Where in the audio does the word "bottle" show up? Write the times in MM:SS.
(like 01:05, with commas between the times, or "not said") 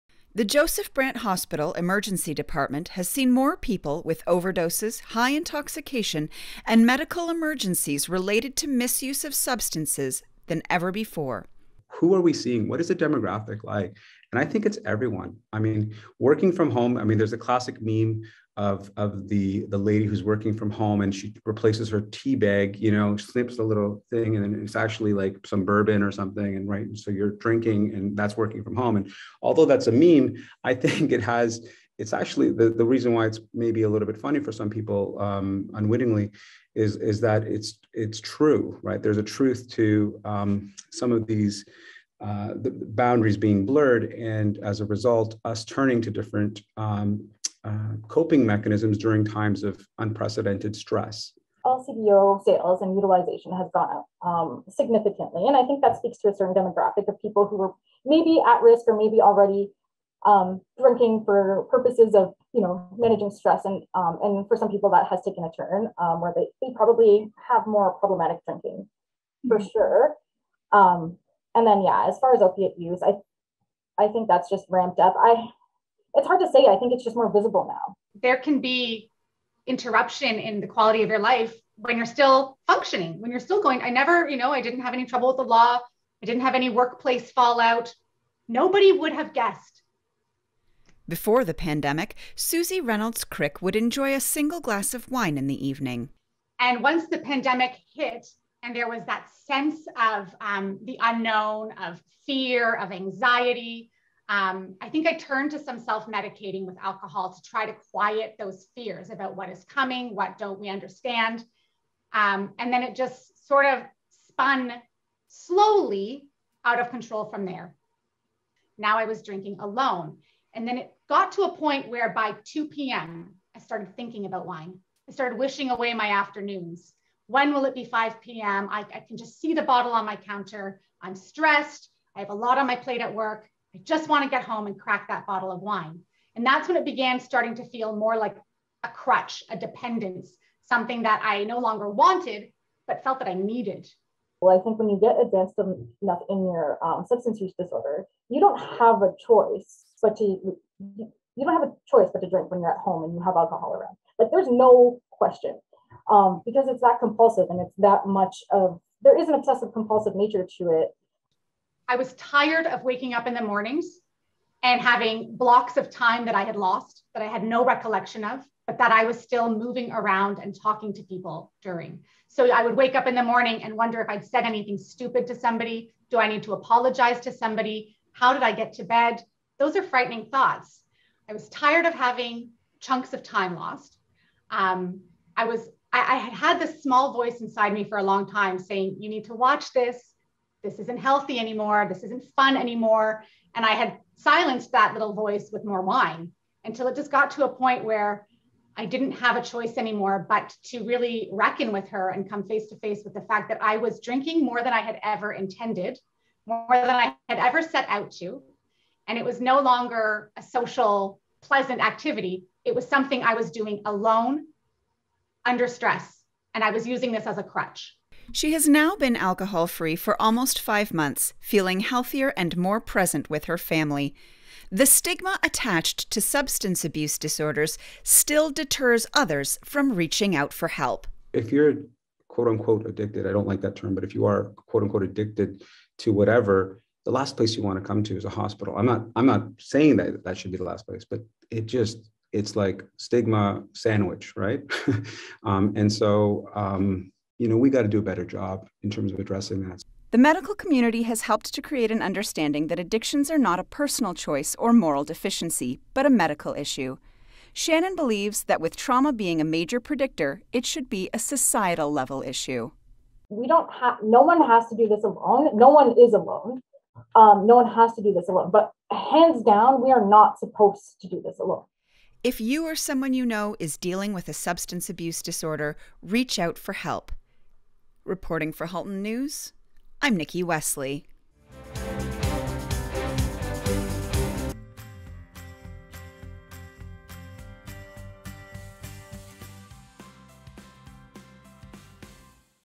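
02:09, 02:15.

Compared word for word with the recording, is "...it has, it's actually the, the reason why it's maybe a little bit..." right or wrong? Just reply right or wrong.
right.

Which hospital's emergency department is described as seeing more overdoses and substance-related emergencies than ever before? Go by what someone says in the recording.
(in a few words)
Joseph Brant Hospital.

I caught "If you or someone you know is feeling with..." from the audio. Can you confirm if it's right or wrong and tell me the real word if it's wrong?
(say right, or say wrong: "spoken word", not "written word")
wrong: "dealing", not "feeling".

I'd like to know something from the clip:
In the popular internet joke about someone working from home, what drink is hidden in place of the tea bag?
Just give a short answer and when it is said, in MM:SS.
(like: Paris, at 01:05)
bourbon, at 00:25.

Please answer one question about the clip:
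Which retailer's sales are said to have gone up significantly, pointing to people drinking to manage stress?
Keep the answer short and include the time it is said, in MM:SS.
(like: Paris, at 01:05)
LCBO, at 00:51.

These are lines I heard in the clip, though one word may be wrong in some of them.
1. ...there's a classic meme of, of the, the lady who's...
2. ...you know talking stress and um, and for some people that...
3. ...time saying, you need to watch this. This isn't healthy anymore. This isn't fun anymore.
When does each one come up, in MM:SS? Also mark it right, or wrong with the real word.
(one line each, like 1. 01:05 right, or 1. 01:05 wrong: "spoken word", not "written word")
1. 00:17 right
2. 01:02 wrong: "managing", not "talking"
3. 03:08 right.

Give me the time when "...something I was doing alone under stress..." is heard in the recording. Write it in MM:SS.
03:32.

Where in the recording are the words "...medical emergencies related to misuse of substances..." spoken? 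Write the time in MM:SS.
00:06.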